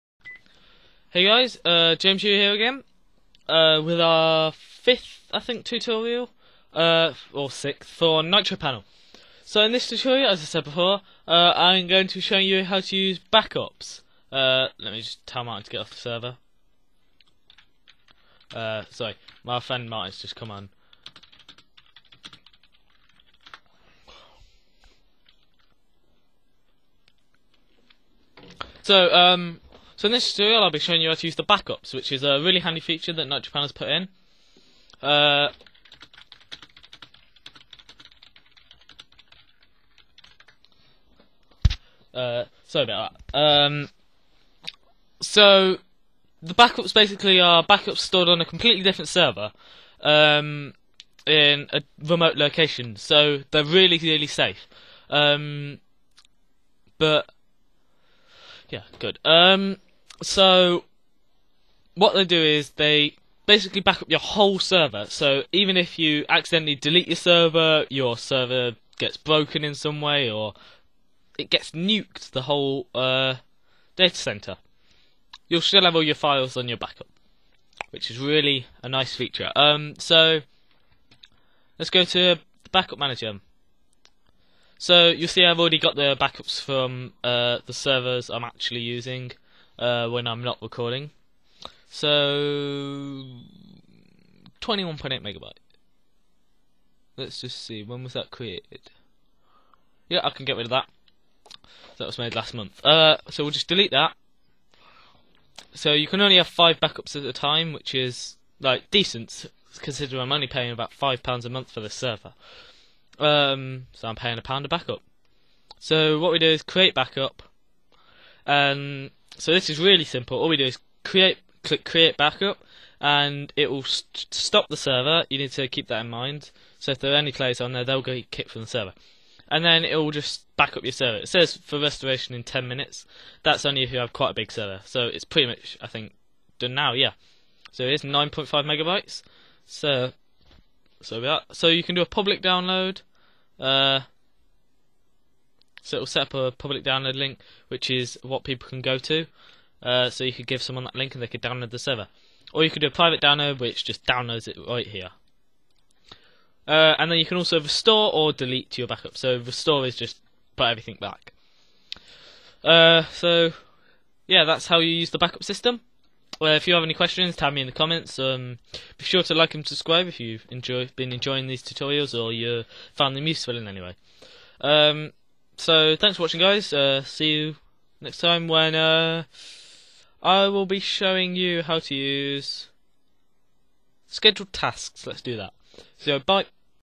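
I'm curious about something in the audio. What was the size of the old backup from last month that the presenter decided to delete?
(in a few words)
21.8 megabytes.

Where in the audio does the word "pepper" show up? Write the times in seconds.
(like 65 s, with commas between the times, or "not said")
not said.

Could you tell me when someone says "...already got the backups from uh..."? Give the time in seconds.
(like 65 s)
85 s.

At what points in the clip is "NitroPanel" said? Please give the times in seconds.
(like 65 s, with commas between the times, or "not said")
8 s, 33 s.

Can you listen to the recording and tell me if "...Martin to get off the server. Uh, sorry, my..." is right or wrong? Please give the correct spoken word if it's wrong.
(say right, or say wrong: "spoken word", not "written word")
right.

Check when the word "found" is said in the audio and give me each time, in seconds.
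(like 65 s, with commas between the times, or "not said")
172 s.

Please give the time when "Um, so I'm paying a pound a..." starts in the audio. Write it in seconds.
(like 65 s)
113 s.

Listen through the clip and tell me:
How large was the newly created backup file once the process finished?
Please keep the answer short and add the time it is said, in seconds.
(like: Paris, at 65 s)
9.5 megabytes, at 138 s.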